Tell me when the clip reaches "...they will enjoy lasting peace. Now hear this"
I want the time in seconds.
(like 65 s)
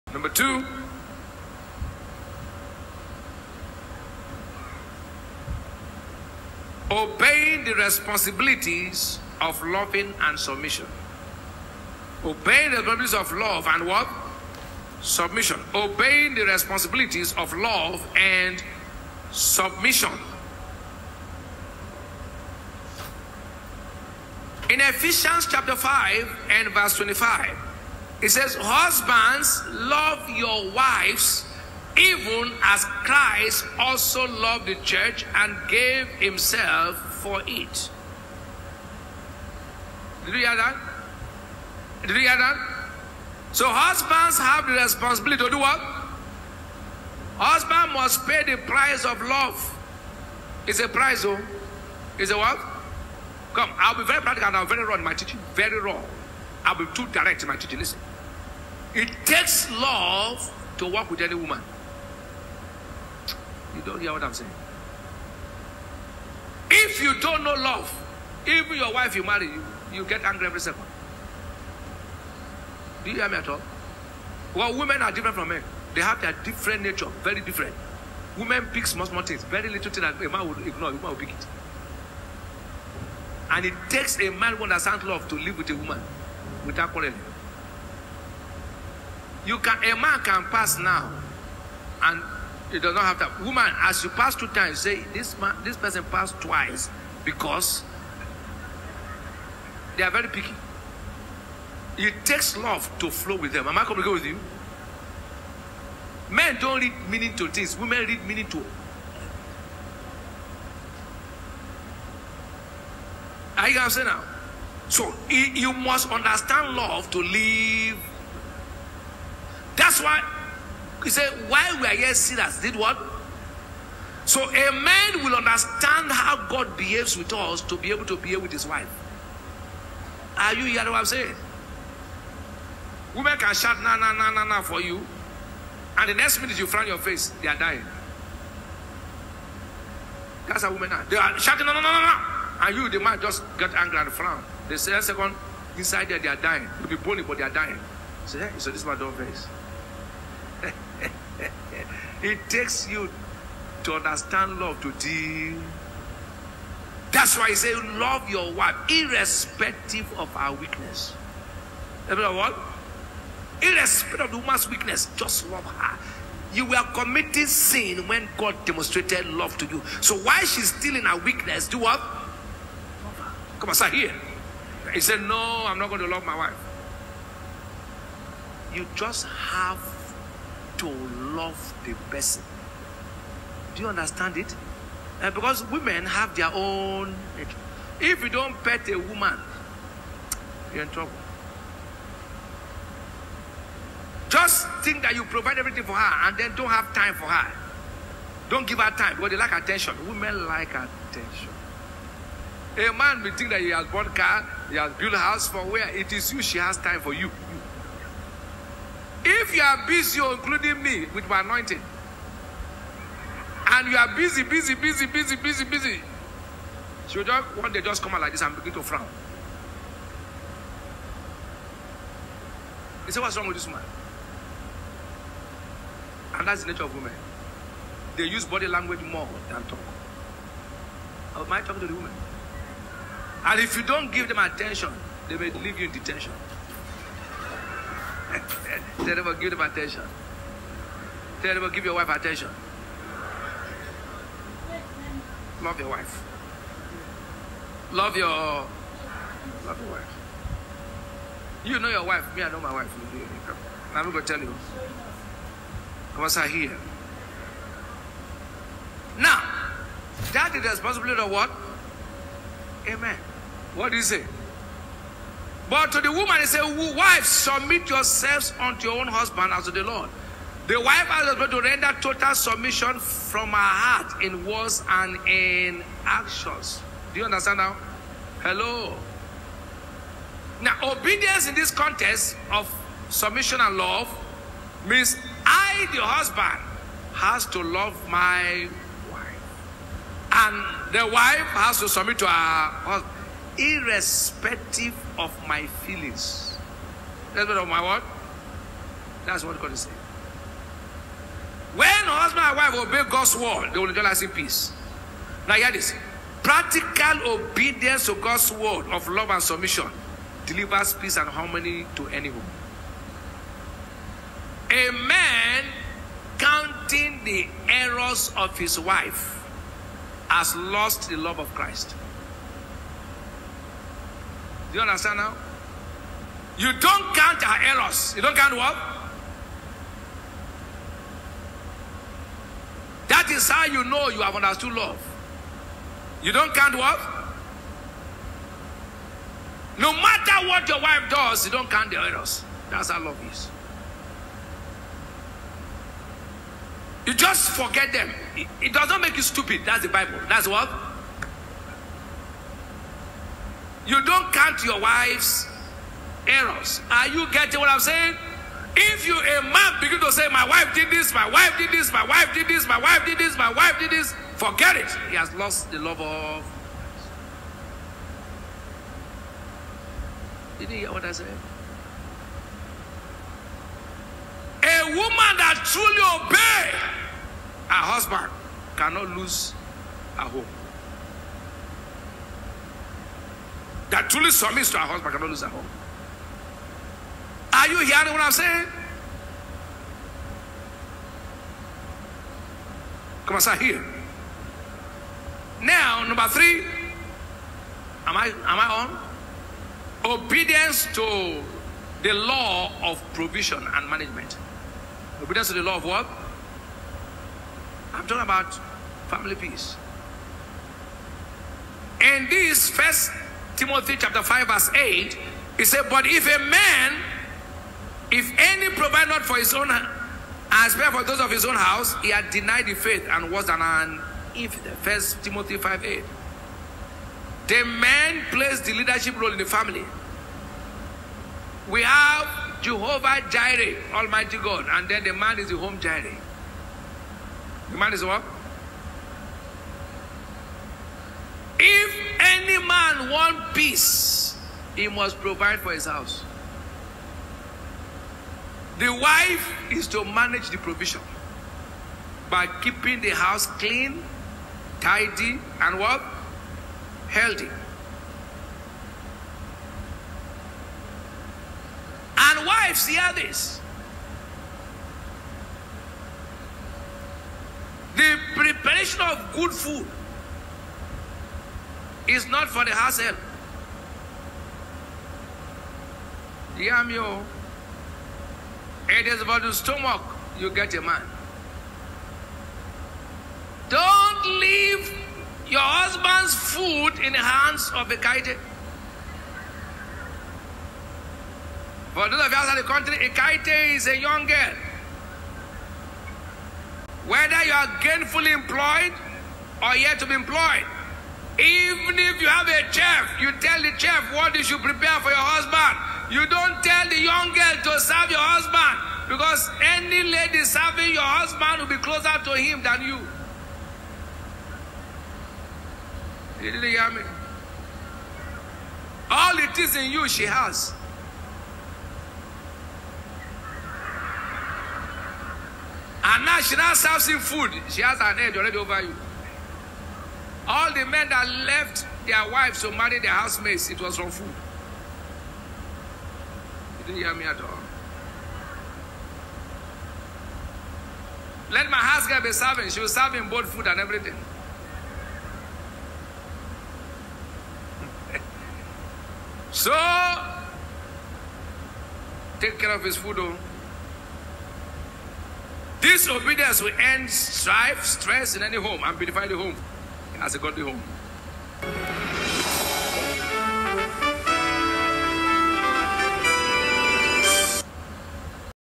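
303 s.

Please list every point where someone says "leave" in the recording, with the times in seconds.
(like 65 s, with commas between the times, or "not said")
235 s, 484 s.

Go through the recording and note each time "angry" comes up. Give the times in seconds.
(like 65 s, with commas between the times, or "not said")
70 s, 143 s.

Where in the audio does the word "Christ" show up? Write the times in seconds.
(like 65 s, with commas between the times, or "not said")
32 s, 321 s.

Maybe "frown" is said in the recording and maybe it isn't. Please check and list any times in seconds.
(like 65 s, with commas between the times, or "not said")
136 s, 144 s, 218 s.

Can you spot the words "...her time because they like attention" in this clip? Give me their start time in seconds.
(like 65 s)
198 s.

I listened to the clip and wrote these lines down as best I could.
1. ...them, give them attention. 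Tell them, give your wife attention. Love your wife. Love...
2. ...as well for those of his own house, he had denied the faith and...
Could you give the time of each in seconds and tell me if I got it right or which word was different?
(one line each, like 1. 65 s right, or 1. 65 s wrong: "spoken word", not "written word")
1. 239 s right
2. 420 s right.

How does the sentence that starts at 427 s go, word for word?
The man plays the leadership role in the family.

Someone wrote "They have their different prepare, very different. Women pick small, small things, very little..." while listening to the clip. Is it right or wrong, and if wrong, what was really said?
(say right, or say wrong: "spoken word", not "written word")
wrong: "nature", not "prepare".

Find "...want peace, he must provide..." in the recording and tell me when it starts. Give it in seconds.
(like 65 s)
443 s.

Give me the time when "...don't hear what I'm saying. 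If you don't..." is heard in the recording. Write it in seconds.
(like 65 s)
63 s.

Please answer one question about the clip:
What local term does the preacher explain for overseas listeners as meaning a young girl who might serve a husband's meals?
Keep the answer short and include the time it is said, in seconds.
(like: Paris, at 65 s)
kaite, at 493 s.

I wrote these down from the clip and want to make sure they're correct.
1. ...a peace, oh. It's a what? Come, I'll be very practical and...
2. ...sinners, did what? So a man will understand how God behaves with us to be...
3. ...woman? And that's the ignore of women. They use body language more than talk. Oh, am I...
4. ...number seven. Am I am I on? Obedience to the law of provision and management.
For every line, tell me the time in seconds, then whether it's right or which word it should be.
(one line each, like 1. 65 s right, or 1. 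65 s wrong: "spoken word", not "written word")
1. 50 s wrong: "price", not "peace"
2. 122 s right
3. 223 s wrong: "nature", not "ignore"
4. 396 s wrong: "three", not "seven".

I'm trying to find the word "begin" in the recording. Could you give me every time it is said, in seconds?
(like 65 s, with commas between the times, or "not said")
218 s, 359 s.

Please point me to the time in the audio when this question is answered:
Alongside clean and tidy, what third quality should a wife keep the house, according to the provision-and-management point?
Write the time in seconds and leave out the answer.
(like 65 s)
457 s.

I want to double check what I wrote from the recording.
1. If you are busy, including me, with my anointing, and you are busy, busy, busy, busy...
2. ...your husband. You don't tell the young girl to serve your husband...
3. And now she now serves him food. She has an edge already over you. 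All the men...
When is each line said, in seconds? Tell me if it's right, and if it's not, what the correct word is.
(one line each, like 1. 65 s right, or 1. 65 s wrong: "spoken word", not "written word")
1. 209 s right
2. 505 s right
3. 526 s right.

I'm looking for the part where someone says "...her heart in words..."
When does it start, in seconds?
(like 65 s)
273 s.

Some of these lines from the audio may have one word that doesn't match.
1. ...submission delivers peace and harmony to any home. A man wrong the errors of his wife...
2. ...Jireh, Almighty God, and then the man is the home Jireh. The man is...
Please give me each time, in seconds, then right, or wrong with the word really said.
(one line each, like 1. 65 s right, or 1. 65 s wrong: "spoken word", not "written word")
1. 309 s wrong: "counting", not "wrong"
2. 433 s right.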